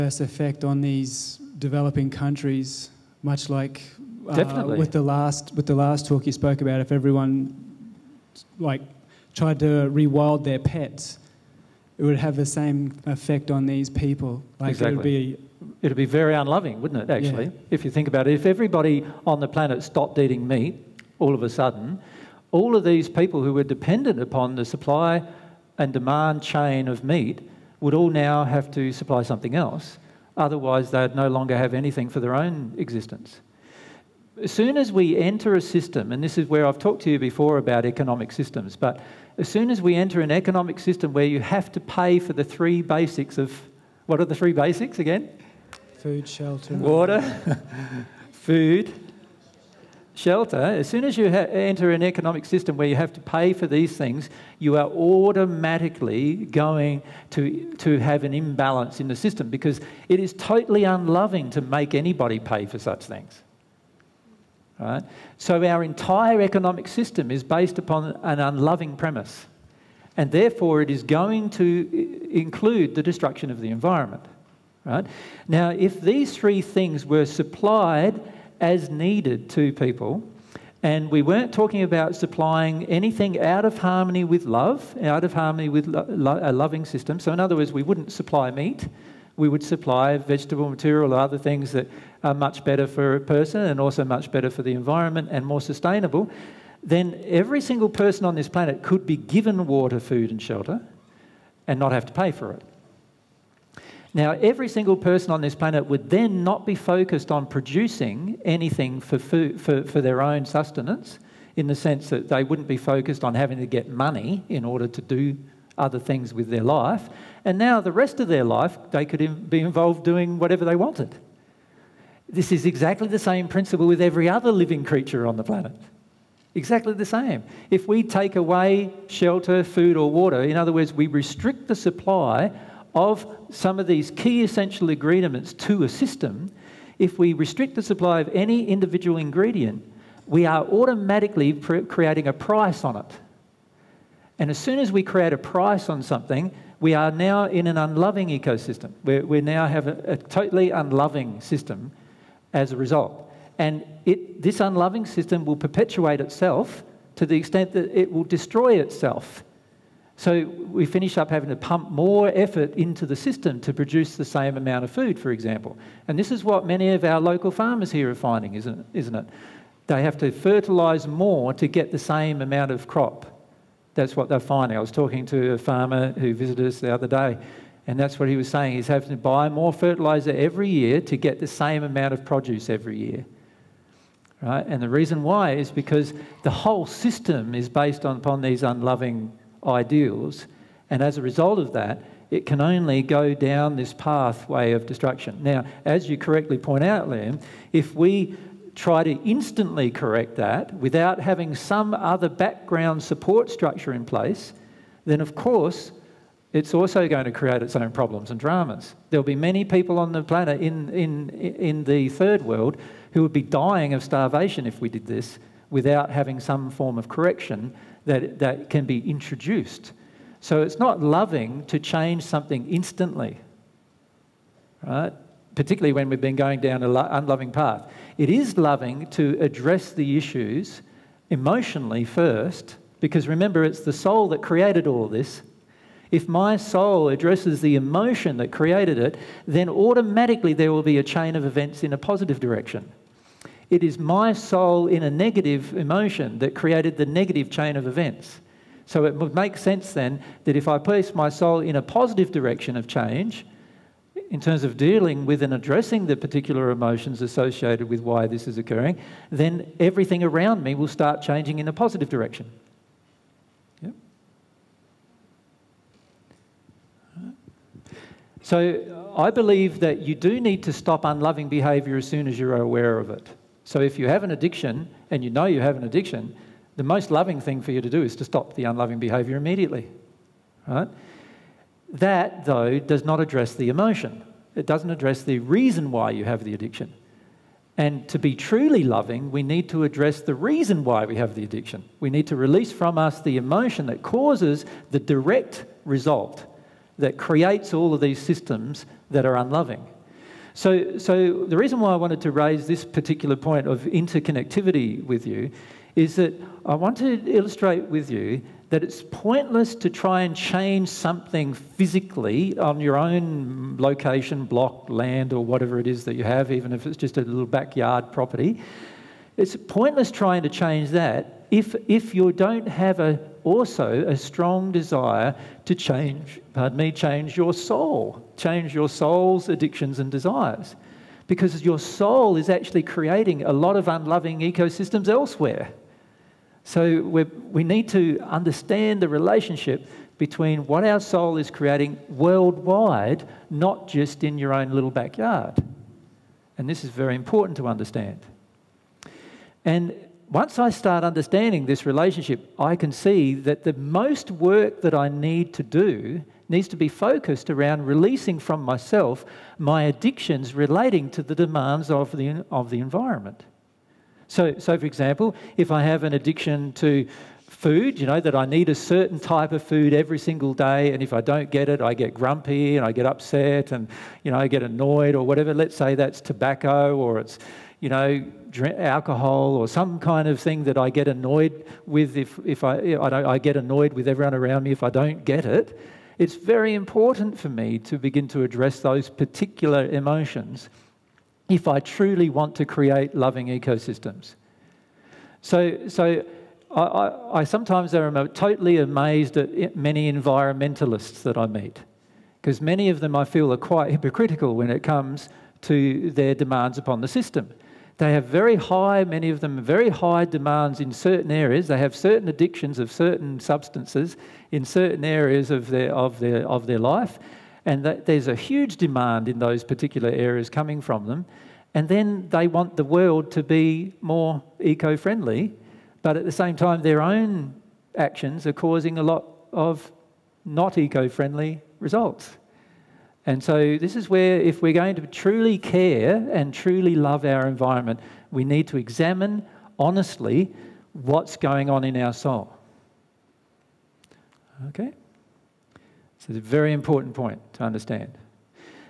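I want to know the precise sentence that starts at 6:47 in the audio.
They have very high, many of them, very high demands in certain areas.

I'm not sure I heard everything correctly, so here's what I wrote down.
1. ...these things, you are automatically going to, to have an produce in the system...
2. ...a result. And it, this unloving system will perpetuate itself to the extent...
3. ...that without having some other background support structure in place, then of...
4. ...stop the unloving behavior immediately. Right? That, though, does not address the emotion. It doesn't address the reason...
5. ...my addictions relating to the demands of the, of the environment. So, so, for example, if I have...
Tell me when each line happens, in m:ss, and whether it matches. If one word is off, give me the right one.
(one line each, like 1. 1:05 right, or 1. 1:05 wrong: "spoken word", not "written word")
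1. 0:53 wrong: "imbalance", not "produce"
2. 2:32 right
3. 3:20 right
4. 4:38 right
5. 5:59 right.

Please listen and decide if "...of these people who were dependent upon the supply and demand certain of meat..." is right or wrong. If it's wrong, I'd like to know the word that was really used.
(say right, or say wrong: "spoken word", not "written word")
wrong: "chain", not "certain".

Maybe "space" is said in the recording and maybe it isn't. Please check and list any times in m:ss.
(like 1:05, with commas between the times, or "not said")
not said.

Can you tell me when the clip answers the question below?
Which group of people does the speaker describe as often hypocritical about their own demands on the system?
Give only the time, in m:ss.
6:40.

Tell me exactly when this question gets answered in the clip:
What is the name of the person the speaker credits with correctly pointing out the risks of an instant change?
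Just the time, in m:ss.
3:17.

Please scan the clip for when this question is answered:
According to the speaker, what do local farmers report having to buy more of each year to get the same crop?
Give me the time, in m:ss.
2:59.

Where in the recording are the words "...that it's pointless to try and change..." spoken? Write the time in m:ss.
5:08.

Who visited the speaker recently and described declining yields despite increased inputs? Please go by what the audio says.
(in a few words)
a farmer.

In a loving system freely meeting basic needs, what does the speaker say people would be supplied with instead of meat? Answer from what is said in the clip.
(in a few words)
vegetable material.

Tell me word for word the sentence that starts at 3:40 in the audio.
So it's not loving to change something instantly, right?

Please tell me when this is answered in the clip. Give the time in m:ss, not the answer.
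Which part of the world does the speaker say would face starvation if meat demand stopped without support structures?
3:31.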